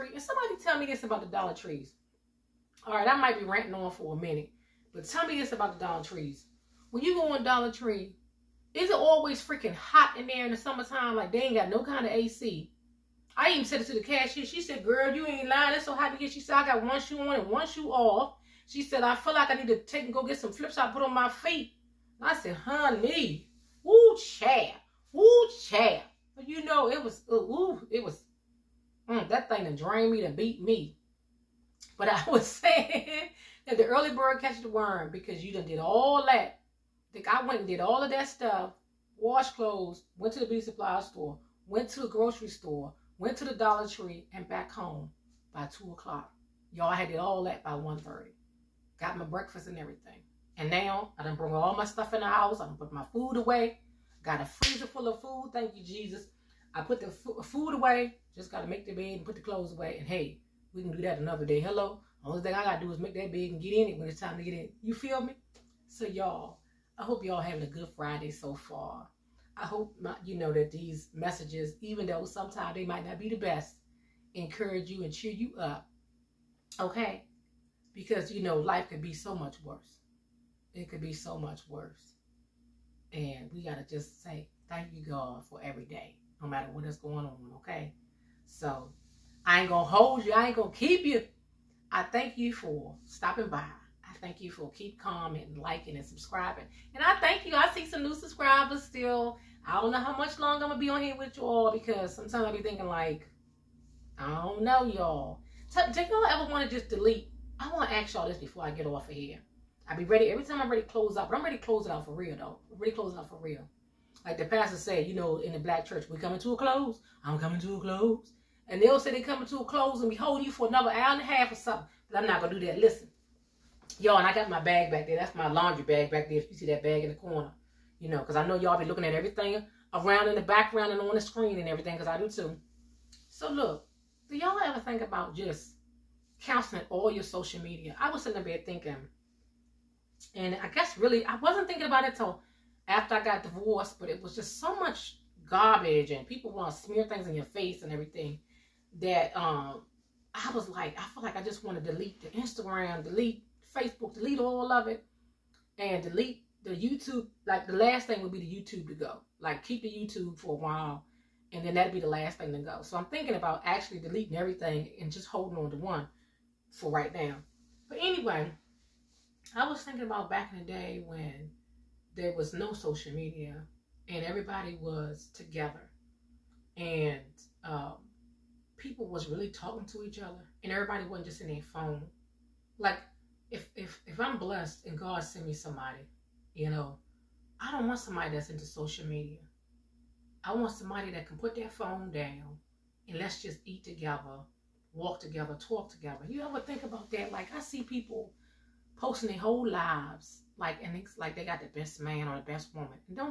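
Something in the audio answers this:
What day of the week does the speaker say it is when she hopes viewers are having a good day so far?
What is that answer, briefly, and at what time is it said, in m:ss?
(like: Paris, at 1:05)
Friday, at 1:07.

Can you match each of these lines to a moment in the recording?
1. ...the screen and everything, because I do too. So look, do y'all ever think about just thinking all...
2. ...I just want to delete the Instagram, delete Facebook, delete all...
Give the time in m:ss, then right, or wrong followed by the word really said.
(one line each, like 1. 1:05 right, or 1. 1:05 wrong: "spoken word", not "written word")
1. 2:11 wrong: "counseling", not "thinking"
2. 2:31 right.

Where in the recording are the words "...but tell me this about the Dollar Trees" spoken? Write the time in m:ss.
0:04.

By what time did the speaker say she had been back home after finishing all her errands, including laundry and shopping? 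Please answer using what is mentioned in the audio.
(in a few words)
2:00.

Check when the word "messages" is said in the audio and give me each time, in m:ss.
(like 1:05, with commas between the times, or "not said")
1:11.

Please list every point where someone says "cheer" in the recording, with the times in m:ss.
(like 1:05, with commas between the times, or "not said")
1:15.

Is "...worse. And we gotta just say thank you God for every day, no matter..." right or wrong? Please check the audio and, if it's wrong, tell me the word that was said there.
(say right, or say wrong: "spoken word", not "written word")
right.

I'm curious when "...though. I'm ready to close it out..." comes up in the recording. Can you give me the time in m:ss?
1:52.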